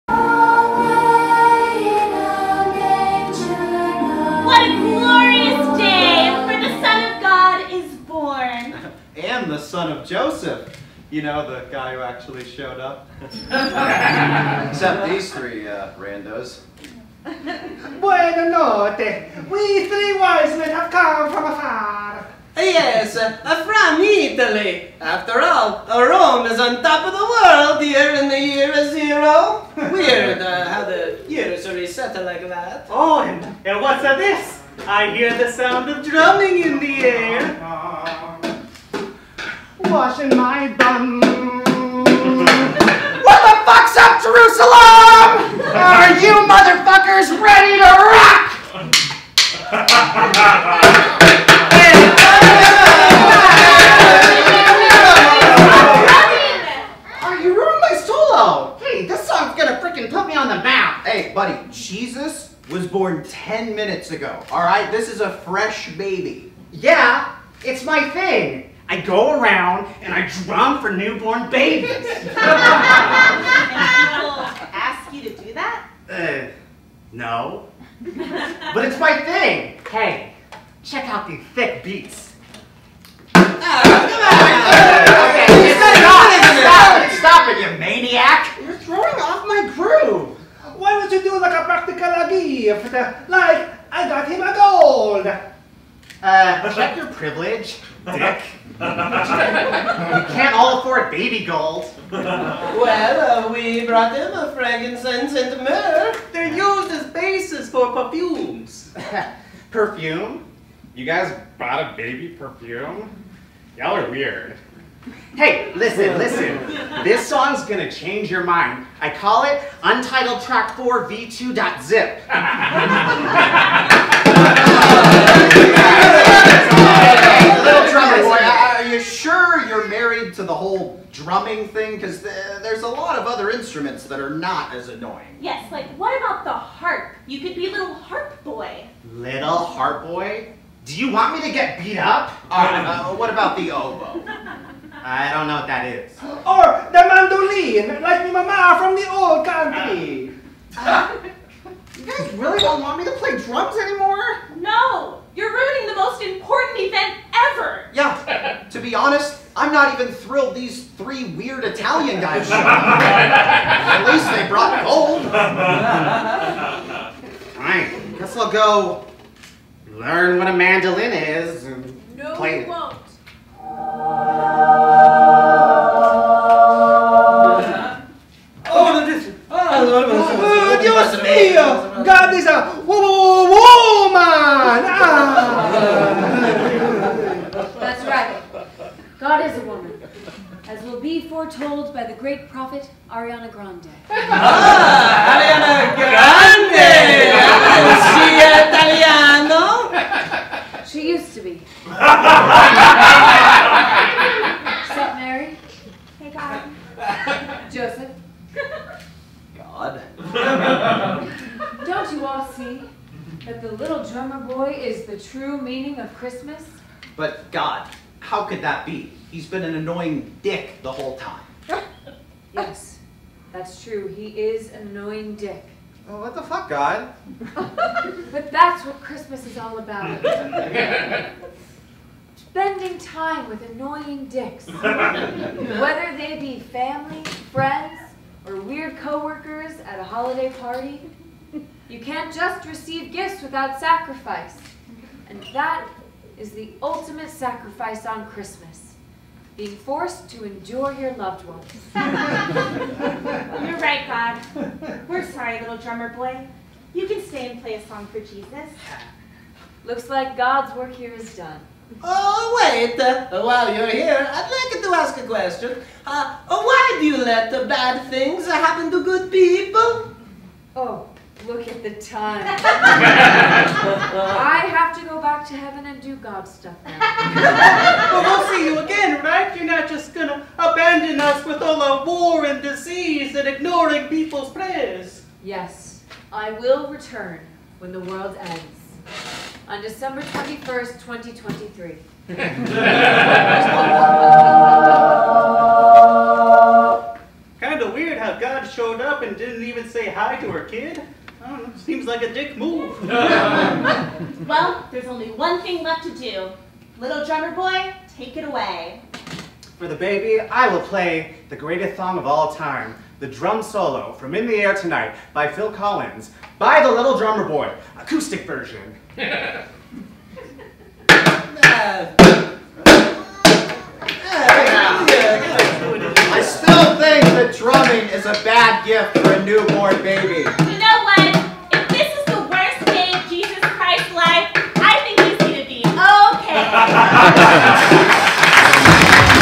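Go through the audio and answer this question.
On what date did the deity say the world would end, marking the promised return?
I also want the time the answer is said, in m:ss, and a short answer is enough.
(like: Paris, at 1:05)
December 21st, 2023, at 4:49.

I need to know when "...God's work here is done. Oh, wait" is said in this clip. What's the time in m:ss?
4:20.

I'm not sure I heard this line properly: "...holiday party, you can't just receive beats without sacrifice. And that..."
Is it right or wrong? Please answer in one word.
wrong.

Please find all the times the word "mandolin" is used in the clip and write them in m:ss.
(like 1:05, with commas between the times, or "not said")
2:27, 2:50.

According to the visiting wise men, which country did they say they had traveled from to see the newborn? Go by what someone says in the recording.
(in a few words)
Italy.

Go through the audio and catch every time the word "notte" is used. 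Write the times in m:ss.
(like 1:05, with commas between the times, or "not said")
0:18.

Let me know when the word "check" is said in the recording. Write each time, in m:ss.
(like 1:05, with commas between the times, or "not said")
1:20, 1:36.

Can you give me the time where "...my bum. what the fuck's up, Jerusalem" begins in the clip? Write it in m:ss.
0:40.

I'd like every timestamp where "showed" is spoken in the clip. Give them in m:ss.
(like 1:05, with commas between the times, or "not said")
0:12, 2:42, 4:58.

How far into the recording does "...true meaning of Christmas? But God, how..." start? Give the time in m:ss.
3:35.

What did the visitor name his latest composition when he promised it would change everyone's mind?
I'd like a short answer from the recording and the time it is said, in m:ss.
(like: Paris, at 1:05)
Untitled Track 4 V2.zip, at 1:59.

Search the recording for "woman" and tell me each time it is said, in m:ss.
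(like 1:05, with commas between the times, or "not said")
3:02, 3:09.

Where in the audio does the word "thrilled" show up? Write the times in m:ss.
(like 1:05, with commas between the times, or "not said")
2:40.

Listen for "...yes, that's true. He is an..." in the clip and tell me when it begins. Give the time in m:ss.
3:42.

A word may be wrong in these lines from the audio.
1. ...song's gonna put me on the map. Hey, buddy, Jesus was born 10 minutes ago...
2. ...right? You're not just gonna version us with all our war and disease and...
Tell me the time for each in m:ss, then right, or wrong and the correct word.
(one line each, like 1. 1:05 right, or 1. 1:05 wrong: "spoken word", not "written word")
1. 0:59 right
2. 4:39 wrong: "abandon", not "version".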